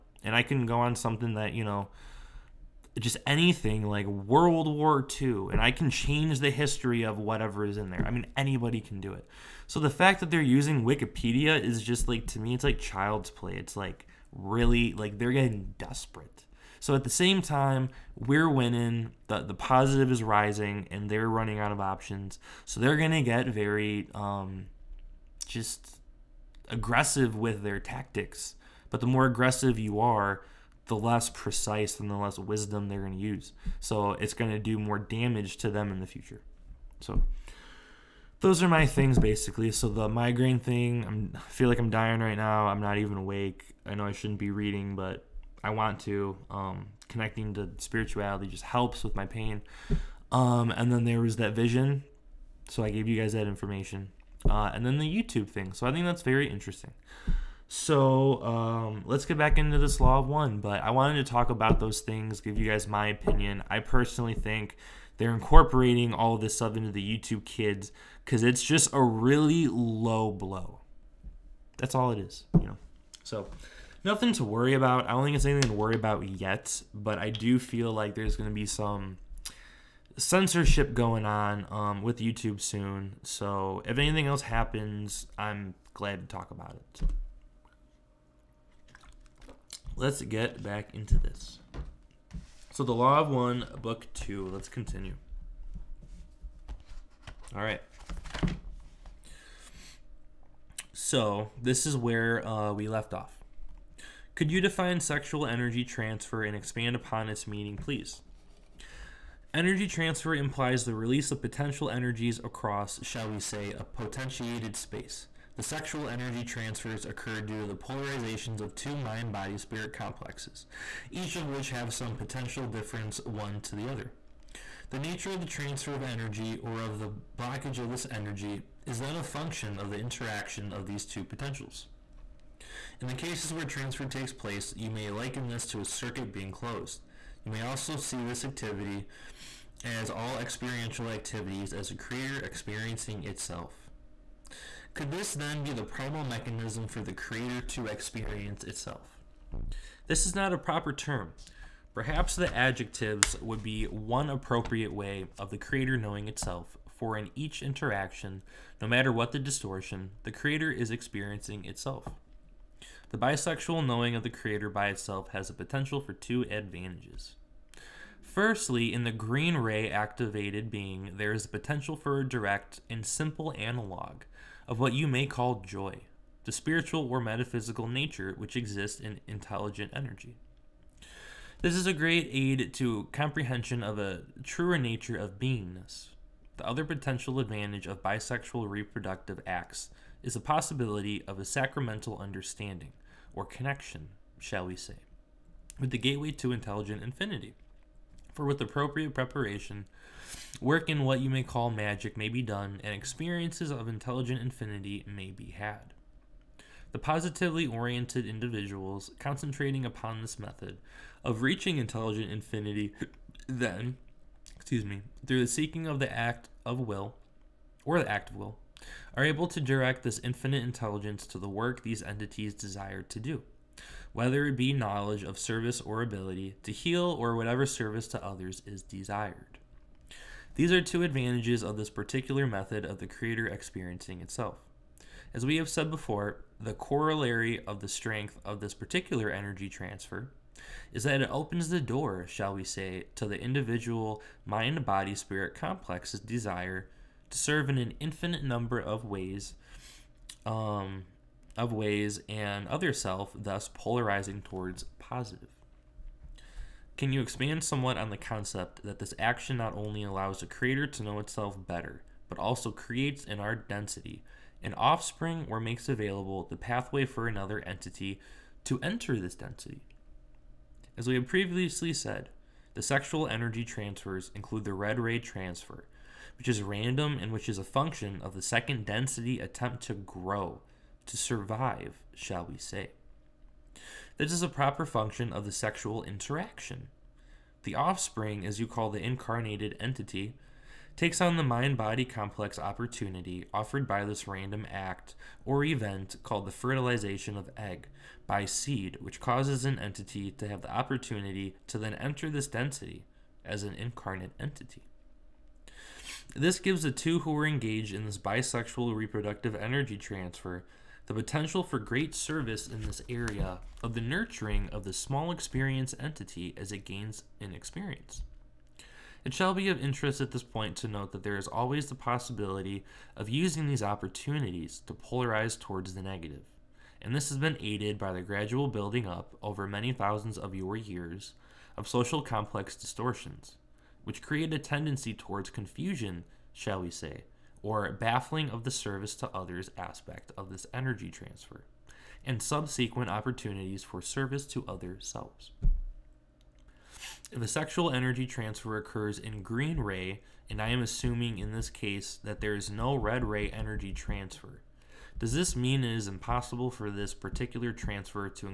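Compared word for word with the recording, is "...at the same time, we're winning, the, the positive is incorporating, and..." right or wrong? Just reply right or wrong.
wrong.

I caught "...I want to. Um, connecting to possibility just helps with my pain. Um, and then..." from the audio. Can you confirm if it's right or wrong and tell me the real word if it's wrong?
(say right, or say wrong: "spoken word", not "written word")
wrong: "spirituality", not "possibility".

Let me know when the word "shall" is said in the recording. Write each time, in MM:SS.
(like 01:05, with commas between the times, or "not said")
01:53, 03:14, 04:02, 04:42, 05:19, 05:36.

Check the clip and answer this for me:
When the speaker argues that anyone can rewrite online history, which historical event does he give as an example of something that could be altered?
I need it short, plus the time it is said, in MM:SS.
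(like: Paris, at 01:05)
World War II, at 00:04.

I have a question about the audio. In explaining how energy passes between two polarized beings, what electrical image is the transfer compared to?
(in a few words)
a circuit being closed.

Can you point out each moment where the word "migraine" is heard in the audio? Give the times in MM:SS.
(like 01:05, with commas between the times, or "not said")
00:40.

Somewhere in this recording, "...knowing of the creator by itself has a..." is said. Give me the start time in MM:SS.
02:43.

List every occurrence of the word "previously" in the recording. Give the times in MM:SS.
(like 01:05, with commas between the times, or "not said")
04:31.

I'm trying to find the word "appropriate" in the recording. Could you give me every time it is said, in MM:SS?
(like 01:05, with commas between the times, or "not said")
02:34, 03:18.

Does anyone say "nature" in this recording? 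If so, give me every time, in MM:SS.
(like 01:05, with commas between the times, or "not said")
02:04, 02:57, 03:04.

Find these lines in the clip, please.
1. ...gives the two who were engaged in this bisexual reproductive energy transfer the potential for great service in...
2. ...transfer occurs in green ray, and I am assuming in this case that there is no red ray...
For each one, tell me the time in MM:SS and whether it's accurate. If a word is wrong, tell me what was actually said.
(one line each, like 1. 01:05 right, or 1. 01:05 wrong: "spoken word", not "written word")
1. 05:06 right
2. 05:48 right.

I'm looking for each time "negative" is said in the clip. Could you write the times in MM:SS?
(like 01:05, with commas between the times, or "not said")
05:26.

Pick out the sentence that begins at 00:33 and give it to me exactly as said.
So it's going to do more damage to them in the future.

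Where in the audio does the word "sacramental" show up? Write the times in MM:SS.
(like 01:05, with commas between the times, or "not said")
03:11.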